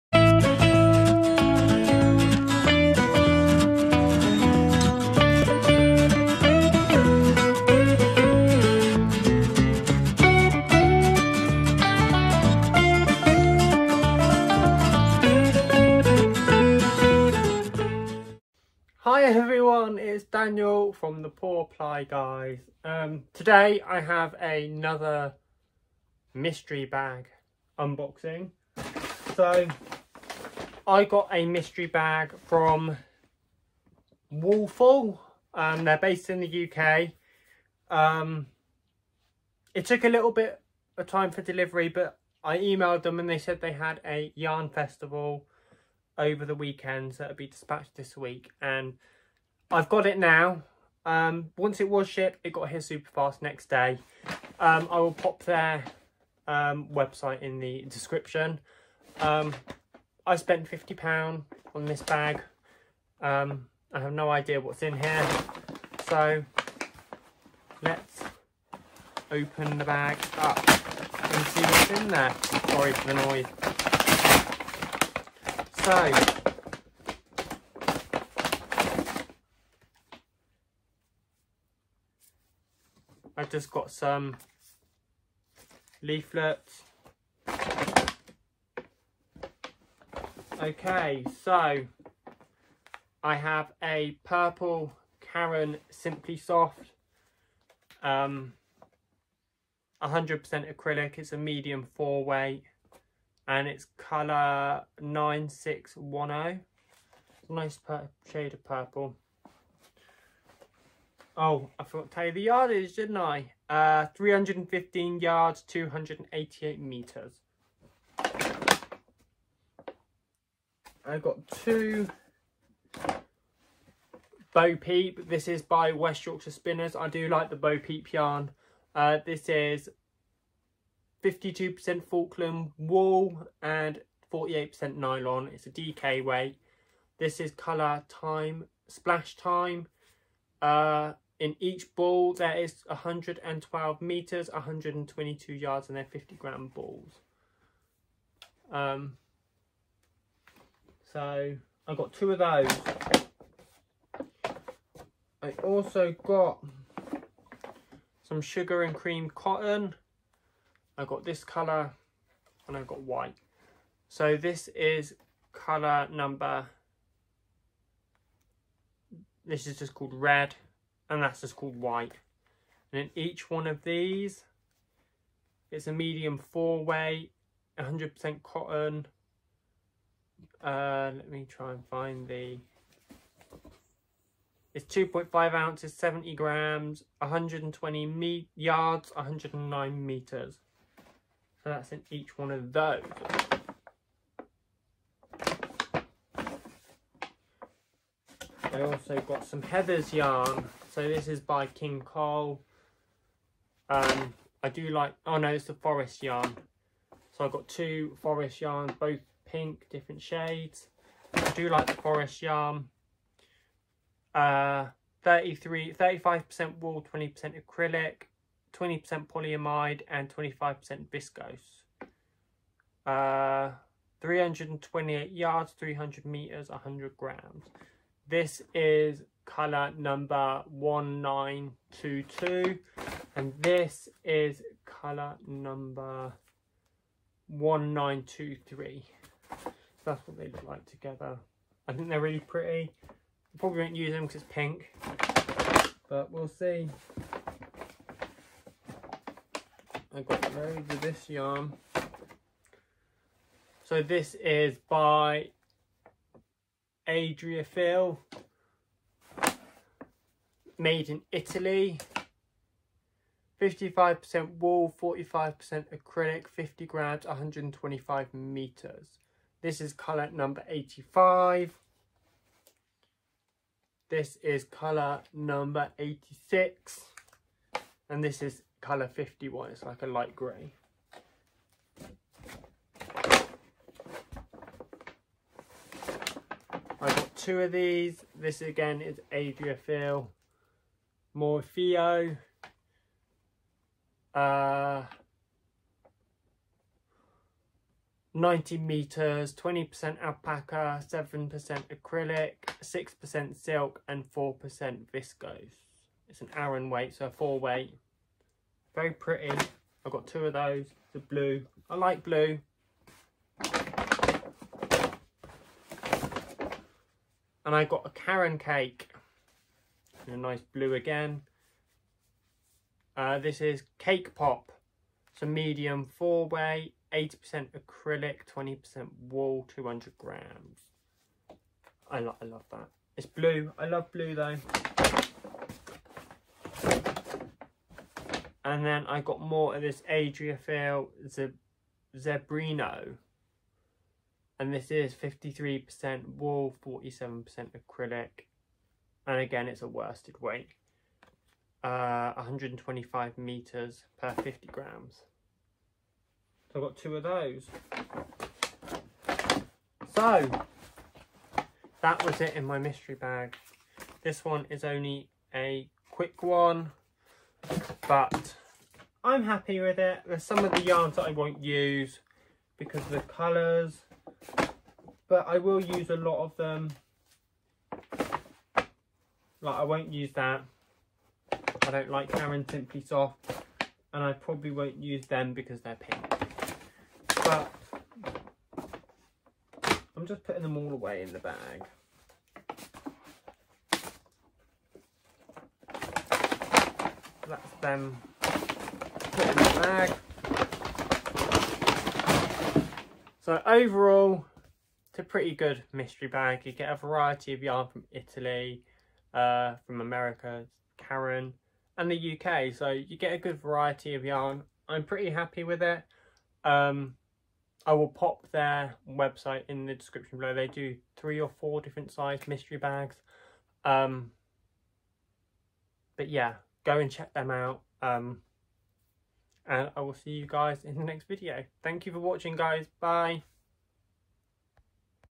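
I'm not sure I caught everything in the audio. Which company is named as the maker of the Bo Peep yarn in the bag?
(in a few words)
West Yorkshire Spinners.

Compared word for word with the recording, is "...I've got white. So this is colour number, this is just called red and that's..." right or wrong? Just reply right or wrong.
right.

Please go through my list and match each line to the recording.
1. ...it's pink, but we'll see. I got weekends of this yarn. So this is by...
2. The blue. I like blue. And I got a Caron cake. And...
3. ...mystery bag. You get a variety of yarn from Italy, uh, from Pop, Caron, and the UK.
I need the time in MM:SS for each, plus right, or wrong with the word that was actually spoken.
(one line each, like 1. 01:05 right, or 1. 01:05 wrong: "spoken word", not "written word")
1. 04:04 wrong: "loads", not "weekends"
2. 05:11 right
3. 06:45 wrong: "America", not "Pop".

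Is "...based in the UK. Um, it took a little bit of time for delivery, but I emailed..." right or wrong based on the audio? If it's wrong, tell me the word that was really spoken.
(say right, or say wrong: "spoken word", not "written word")
right.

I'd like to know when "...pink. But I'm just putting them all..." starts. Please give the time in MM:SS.
06:25.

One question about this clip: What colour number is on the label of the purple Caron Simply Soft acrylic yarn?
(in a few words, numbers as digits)
9610.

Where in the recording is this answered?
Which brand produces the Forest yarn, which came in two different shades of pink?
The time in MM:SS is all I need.
03:21.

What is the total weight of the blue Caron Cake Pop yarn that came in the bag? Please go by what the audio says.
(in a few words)
200 grams.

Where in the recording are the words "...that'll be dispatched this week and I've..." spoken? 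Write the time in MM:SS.
00:47.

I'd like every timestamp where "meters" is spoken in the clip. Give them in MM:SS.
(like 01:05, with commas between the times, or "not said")
03:10, 03:46, 04:28, 04:58, 05:53.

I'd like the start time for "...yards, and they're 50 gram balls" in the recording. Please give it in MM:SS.
02:25.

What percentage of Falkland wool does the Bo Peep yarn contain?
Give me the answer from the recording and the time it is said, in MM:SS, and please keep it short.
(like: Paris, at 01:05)
52%, at 02:11.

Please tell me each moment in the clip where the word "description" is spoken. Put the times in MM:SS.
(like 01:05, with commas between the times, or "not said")
00:57, 06:59.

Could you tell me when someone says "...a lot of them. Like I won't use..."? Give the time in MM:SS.
06:16.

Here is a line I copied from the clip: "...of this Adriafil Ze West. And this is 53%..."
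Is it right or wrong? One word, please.
wrong.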